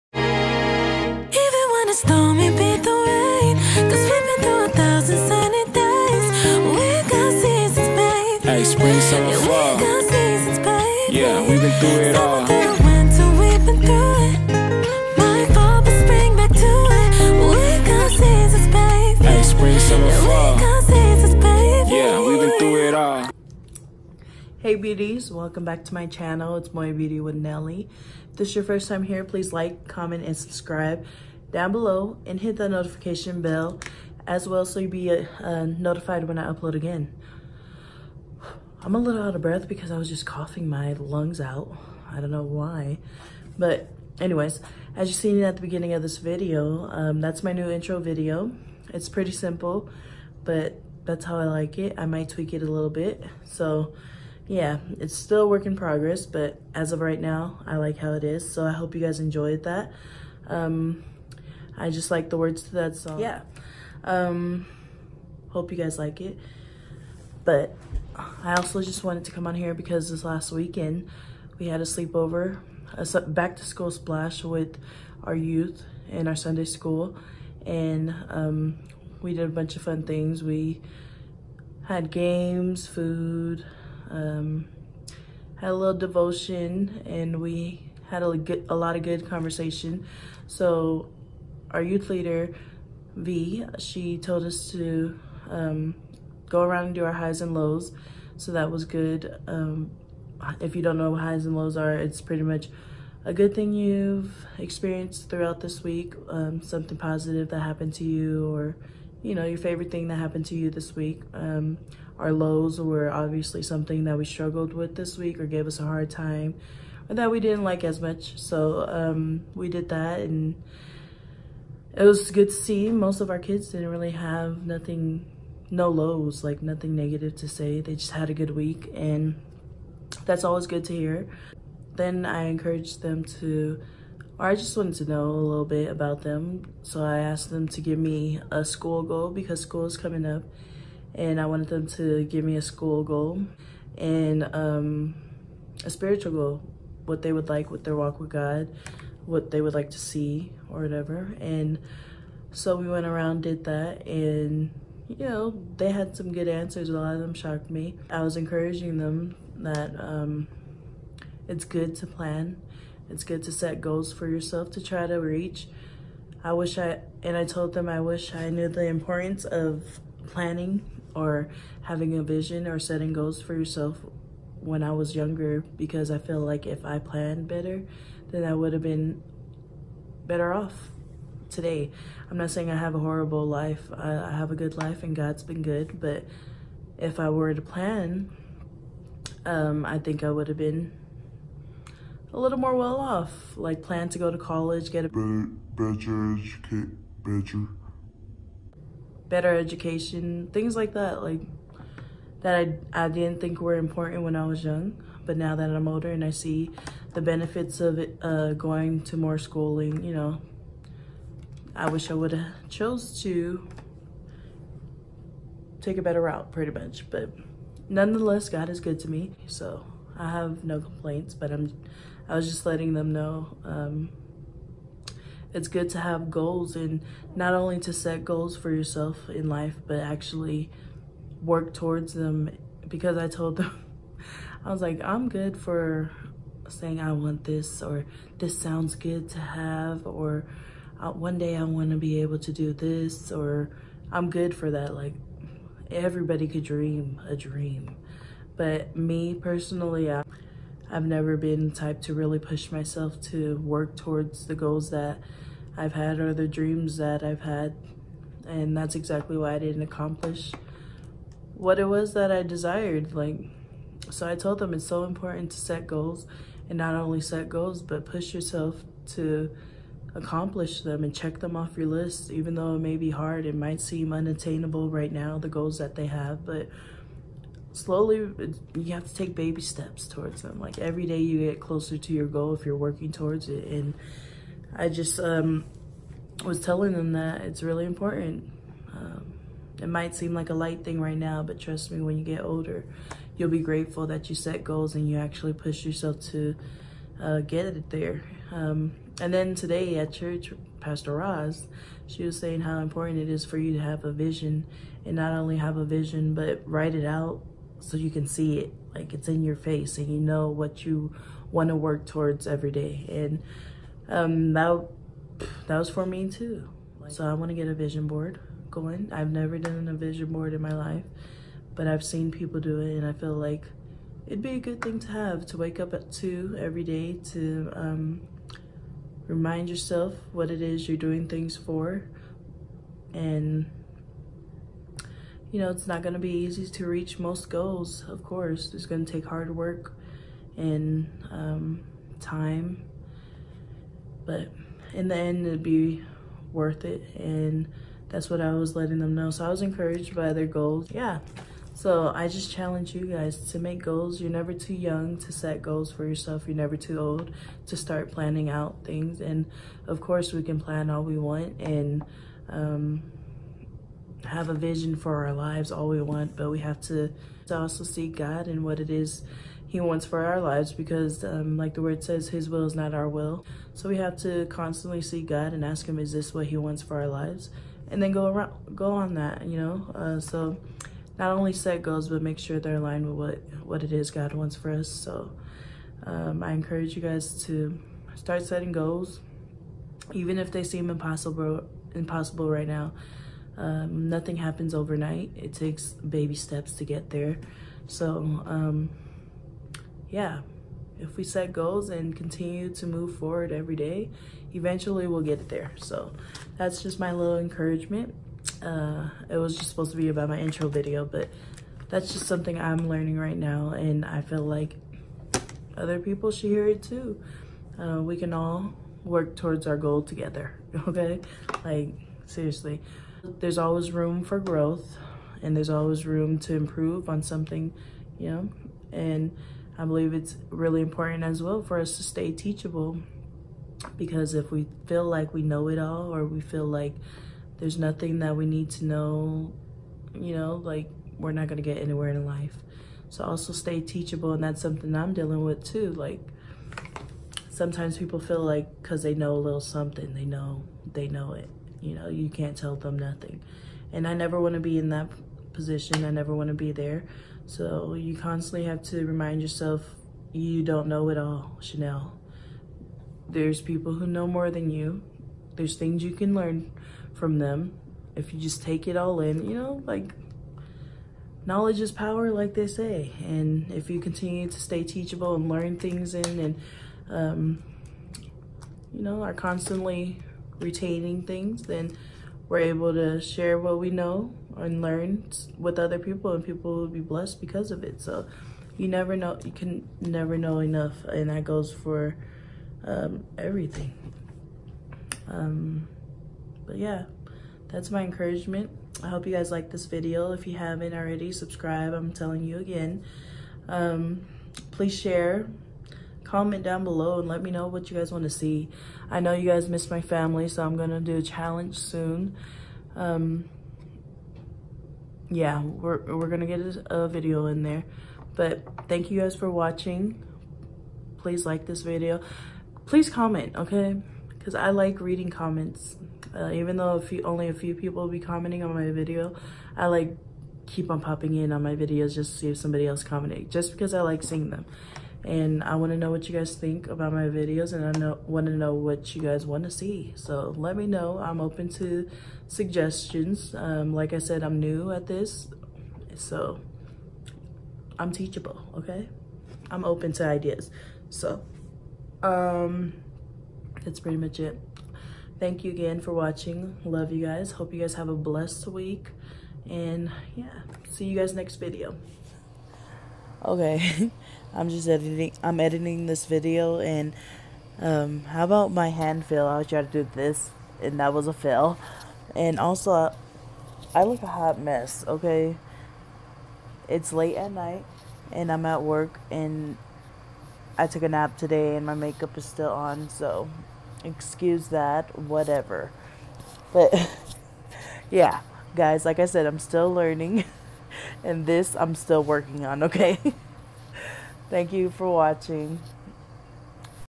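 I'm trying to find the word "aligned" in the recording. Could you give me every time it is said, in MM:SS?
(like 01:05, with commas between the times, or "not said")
06:22.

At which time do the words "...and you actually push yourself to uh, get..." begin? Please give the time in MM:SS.
04:54.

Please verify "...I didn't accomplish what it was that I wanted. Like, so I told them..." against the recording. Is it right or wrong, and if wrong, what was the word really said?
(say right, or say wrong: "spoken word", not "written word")
wrong: "desired", not "wanted".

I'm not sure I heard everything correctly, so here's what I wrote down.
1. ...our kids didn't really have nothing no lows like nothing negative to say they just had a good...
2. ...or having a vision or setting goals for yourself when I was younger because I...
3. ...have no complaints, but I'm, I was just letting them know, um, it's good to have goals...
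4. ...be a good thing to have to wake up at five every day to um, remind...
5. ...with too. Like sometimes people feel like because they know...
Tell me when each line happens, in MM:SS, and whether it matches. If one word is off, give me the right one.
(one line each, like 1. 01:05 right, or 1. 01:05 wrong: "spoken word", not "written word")
1. 02:03 right
2. 02:51 right
3. 03:40 right
4. 05:24 wrong: "two", not "five"
5. 07:25 right.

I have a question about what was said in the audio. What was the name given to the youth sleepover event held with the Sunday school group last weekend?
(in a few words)
back to school splash.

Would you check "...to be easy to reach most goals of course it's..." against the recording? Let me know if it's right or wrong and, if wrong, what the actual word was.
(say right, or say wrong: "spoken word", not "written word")
right.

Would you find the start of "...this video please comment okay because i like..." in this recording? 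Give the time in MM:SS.
08:41.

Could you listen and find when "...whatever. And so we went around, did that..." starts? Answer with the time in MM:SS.
02:30.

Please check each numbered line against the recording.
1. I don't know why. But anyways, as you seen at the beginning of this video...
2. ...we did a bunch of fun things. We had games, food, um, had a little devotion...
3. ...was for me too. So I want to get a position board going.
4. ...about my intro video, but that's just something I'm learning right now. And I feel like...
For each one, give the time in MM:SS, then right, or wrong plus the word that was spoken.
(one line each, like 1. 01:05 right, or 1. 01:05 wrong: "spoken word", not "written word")
1. 00:42 right
2. 01:19 right
3. 05:15 wrong: "vision", not "position"
4. 06:50 right.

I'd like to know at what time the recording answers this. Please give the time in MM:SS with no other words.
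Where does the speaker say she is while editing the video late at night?
09:38.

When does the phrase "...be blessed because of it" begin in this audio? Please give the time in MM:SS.
08:06.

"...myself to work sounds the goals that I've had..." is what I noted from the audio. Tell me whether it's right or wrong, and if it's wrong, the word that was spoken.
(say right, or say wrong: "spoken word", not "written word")
wrong: "towards", not "sounds".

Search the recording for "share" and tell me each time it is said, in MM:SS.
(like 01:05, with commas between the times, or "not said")
08:03, 08:24.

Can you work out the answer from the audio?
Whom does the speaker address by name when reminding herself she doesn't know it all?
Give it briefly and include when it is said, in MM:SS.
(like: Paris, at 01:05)
Chanel, at 07:41.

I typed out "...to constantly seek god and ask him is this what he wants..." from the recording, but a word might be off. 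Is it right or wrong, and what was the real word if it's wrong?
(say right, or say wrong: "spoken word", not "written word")
right.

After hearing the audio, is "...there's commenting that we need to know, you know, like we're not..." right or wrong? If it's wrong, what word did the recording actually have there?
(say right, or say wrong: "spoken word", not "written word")
wrong: "nothing", not "commenting".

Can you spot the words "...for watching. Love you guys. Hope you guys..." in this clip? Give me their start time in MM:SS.
09:15.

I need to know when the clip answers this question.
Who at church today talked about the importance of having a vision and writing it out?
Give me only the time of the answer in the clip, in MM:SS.
05:00.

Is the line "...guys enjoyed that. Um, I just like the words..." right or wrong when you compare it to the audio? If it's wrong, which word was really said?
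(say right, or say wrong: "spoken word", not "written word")
right.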